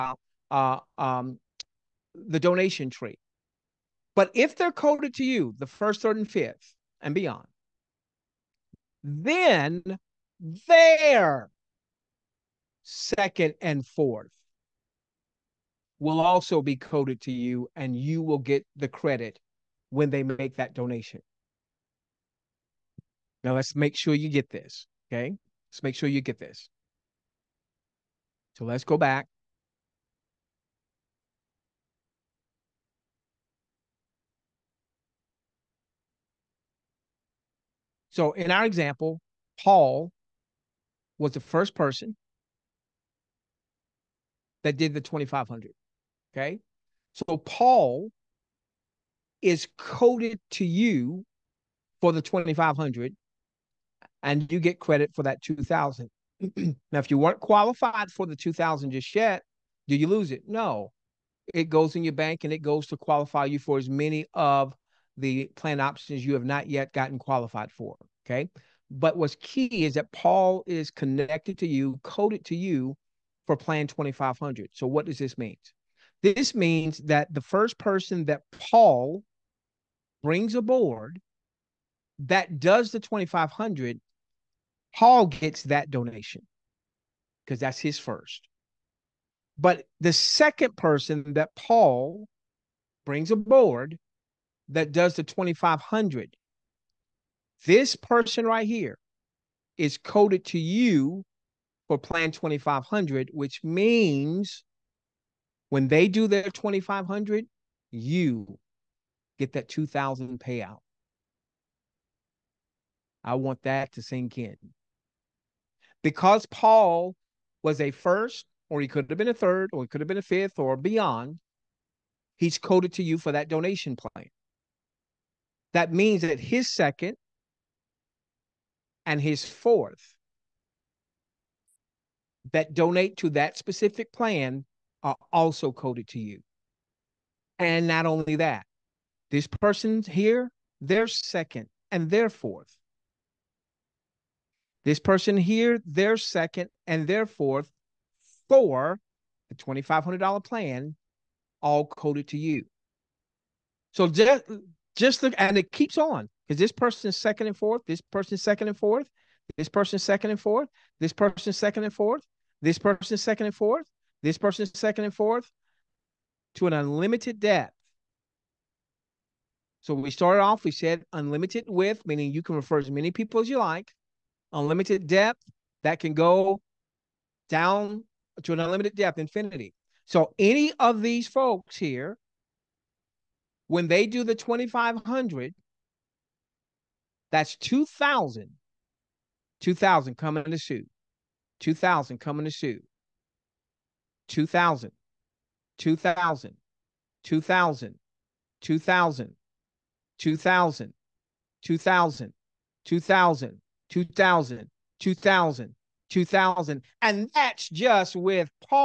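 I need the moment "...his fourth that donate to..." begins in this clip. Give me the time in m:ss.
2:09.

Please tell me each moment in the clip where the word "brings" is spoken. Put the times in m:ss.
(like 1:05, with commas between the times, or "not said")
1:20, 1:33.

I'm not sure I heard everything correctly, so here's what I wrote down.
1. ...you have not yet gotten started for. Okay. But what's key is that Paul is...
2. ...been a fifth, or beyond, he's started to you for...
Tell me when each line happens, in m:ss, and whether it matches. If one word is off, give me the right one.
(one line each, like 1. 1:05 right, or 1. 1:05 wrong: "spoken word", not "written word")
1. 1:06 wrong: "qualified", not "started"
2. 2:00 wrong: "coded", not "started".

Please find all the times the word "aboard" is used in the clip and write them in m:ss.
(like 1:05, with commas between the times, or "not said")
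1:20, 1:33.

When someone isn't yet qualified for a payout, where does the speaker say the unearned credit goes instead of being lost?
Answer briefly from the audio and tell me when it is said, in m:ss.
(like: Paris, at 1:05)
your bank, at 1:01.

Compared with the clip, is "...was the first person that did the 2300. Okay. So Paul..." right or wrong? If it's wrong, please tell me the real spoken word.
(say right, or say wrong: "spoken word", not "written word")
wrong: "2500", not "2300".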